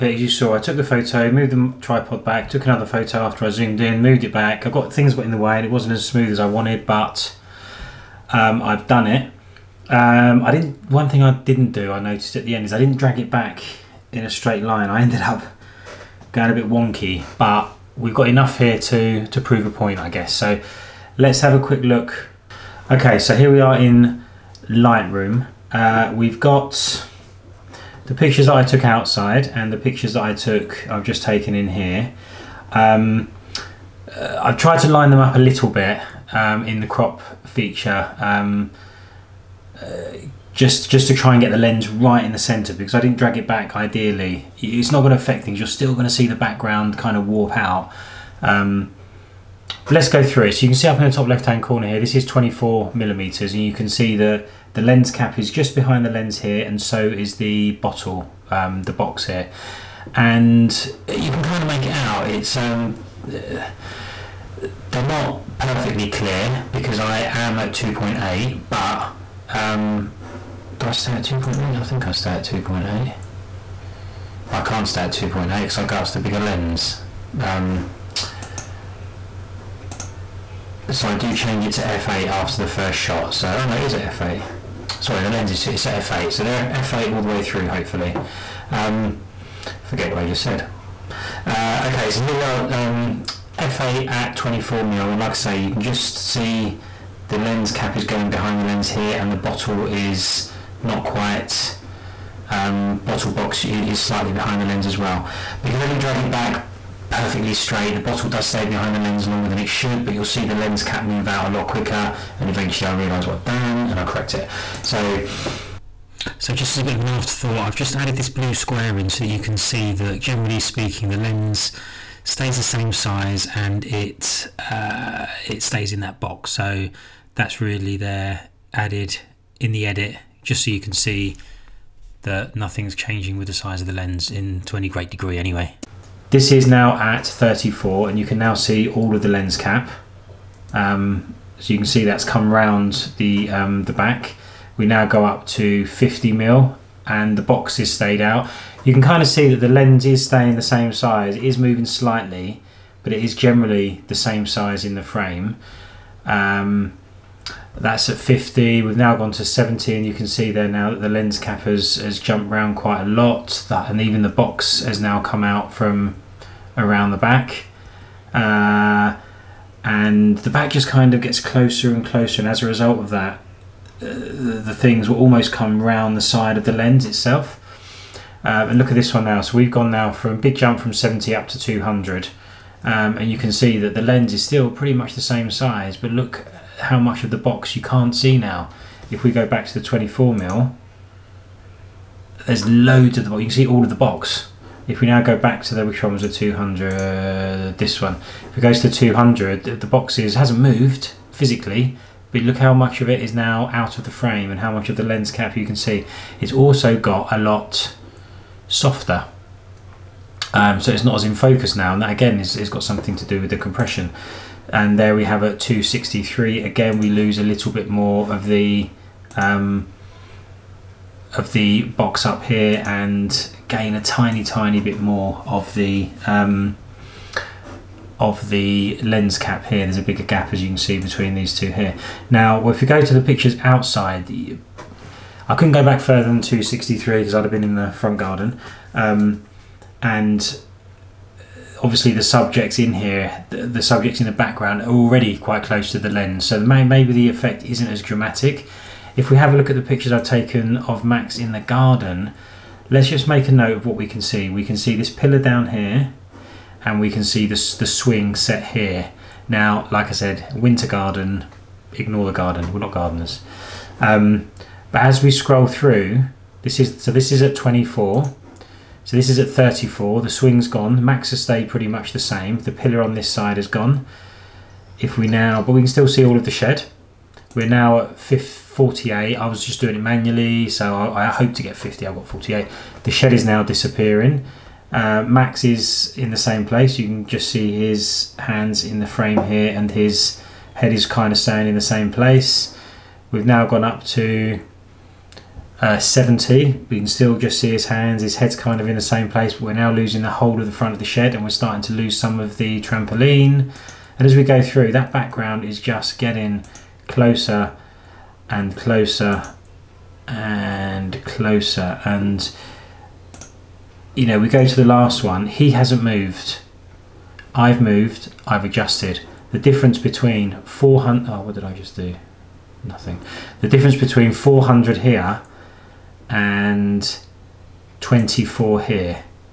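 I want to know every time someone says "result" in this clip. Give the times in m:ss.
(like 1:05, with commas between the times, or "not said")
2:52.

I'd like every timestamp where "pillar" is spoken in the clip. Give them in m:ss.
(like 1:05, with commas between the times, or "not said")
4:15, 4:32.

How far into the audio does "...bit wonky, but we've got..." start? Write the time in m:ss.
0:16.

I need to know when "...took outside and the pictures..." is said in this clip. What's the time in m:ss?
0:28.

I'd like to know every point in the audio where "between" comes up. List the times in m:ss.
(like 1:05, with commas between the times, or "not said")
3:50, 5:19, 5:23.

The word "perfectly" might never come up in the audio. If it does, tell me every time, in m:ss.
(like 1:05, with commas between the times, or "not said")
1:05, 1:47.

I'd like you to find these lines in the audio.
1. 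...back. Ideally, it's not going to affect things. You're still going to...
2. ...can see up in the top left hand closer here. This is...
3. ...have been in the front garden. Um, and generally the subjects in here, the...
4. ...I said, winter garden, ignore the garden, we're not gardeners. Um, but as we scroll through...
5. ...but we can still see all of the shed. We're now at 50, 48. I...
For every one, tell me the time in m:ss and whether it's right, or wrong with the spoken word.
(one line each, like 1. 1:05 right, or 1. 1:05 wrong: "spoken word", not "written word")
1. 0:43 right
2. 0:50 wrong: "corner", not "closer"
3. 3:57 wrong: "obviously", not "generally"
4. 4:20 right
5. 4:35 right.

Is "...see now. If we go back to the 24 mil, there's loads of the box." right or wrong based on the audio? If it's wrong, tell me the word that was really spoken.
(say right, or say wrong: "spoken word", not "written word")
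right.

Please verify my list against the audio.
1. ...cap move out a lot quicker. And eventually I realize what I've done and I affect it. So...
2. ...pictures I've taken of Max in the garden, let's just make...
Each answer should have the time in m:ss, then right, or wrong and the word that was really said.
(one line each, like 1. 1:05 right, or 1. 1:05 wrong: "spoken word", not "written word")
1. 1:50 wrong: "correct", not "affect"
2. 4:09 right.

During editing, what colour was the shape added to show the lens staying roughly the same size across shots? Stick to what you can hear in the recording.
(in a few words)
Blue.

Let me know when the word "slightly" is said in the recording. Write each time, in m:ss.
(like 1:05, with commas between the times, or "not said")
1:44, 2:31.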